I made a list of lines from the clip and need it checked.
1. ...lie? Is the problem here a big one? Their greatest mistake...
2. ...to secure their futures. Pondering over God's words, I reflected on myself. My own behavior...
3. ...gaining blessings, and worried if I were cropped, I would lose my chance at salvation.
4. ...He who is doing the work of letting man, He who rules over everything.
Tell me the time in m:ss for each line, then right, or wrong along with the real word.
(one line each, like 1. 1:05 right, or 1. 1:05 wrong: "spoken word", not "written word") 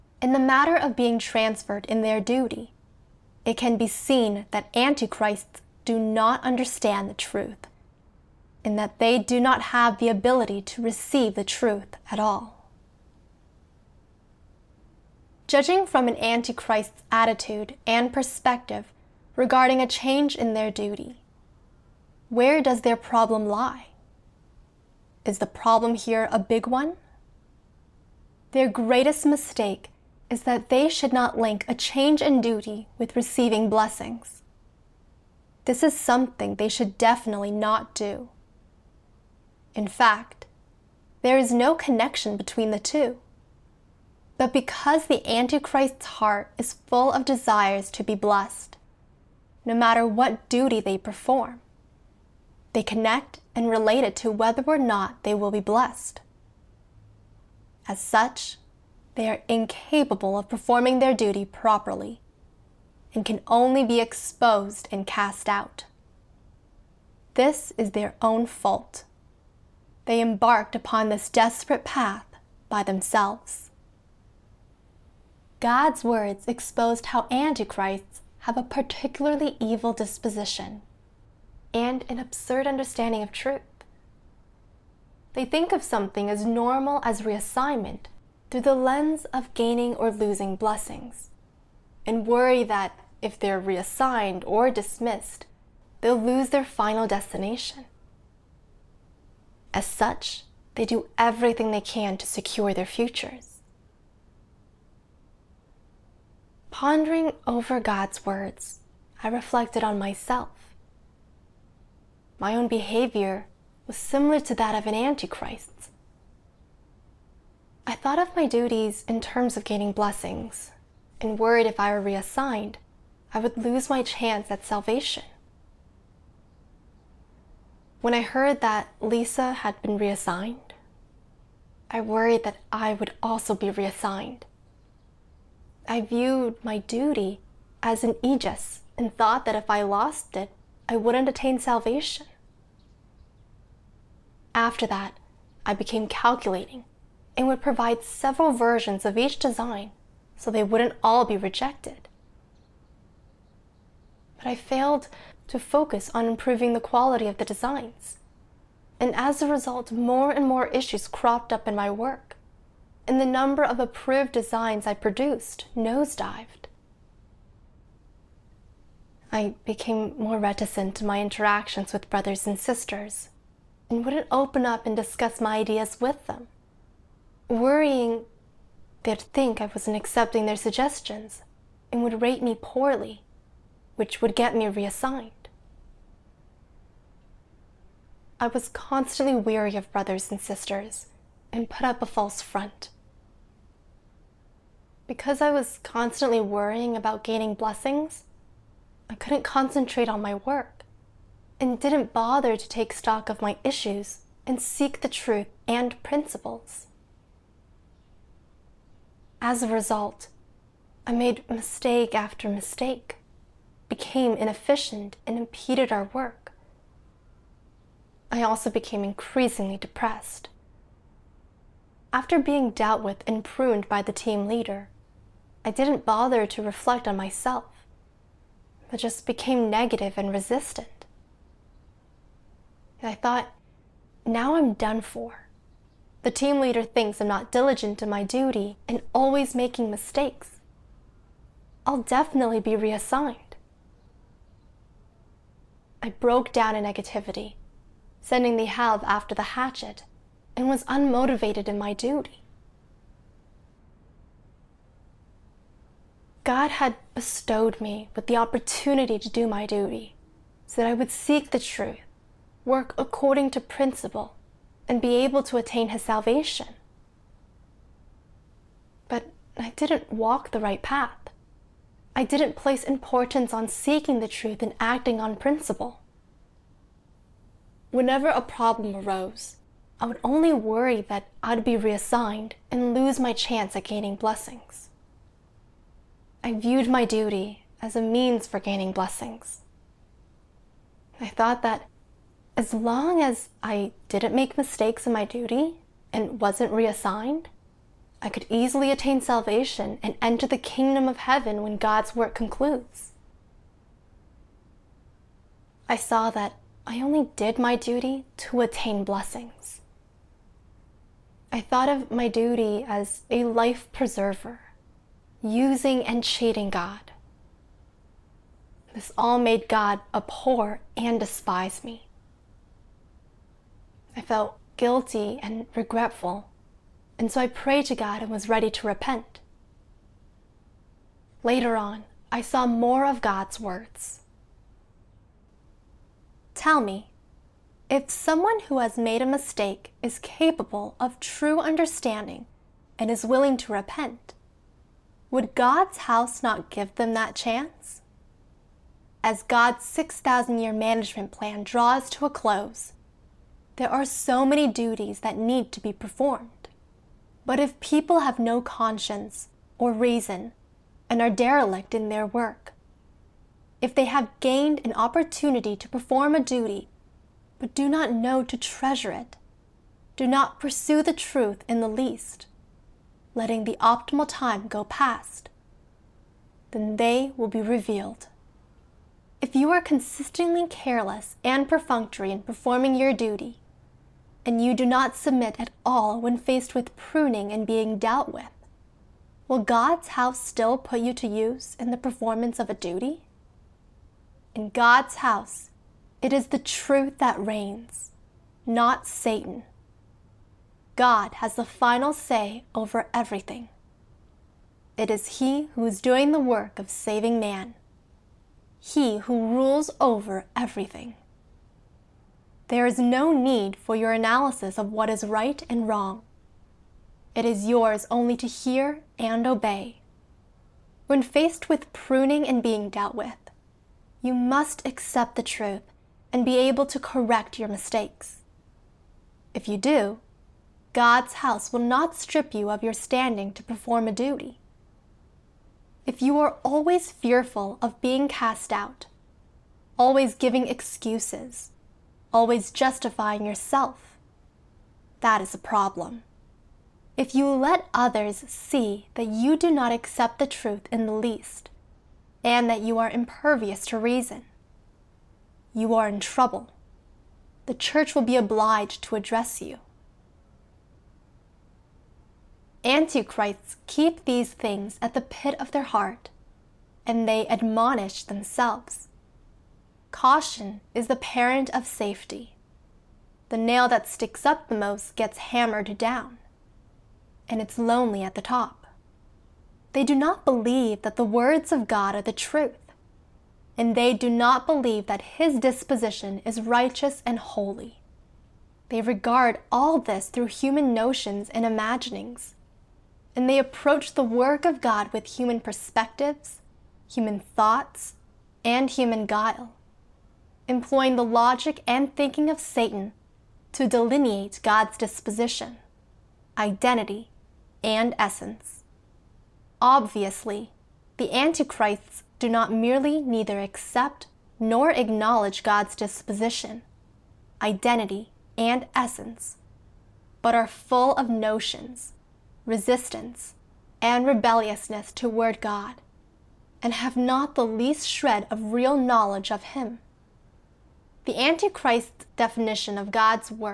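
1. 0:23 right
2. 1:42 right
3. 1:59 wrong: "reassigned", not "cropped"
4. 6:45 wrong: "saving", not "letting".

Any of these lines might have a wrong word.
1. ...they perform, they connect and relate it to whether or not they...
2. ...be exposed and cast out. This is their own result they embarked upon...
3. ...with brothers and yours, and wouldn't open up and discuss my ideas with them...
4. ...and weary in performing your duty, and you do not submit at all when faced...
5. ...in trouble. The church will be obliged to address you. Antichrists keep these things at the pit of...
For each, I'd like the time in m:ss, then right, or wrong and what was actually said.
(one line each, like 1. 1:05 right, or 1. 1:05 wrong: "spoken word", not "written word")
1. 0:50 right
2. 1:03 wrong: "fault", not "result"
3. 2:51 wrong: "sisters", not "yours"
4. 6:21 wrong: "perfunctory", not "weary"
5. 7:36 right.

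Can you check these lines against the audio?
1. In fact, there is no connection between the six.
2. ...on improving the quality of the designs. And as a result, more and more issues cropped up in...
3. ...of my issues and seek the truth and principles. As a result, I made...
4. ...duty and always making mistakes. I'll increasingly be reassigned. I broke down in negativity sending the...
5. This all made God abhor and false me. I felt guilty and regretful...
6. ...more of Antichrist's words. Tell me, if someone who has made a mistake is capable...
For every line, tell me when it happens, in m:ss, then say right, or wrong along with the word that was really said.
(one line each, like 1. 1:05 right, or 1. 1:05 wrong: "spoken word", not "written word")
1. 0:39 wrong: "two", not "six"
2. 2:36 right
3. 3:23 right
4. 3:58 wrong: "definitely", not "increasingly"
5. 5:18 wrong: "despise", not "false"
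6. 5:32 wrong: "God", not "Antichrist".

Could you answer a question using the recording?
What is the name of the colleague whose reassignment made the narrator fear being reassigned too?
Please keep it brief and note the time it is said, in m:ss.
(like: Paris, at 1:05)
Lisa, at 2:09.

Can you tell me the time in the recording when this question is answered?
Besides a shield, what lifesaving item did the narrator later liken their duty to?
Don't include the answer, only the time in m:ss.
5:13.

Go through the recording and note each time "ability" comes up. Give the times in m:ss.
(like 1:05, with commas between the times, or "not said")
0:10.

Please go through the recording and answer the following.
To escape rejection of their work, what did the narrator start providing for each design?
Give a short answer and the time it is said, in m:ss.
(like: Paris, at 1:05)
several versions, at 2:28.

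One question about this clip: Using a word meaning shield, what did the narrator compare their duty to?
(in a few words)
an aegis.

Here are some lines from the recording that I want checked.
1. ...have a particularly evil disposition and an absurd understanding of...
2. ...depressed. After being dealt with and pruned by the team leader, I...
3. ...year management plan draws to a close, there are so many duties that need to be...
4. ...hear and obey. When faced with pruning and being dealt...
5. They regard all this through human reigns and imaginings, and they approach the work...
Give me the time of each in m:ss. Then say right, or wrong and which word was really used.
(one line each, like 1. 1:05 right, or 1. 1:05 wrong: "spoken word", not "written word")
1. 1:18 right
2. 3:39 right
3. 5:50 right
4. 6:58 right
5. 8:08 wrong: "notions", not "reigns".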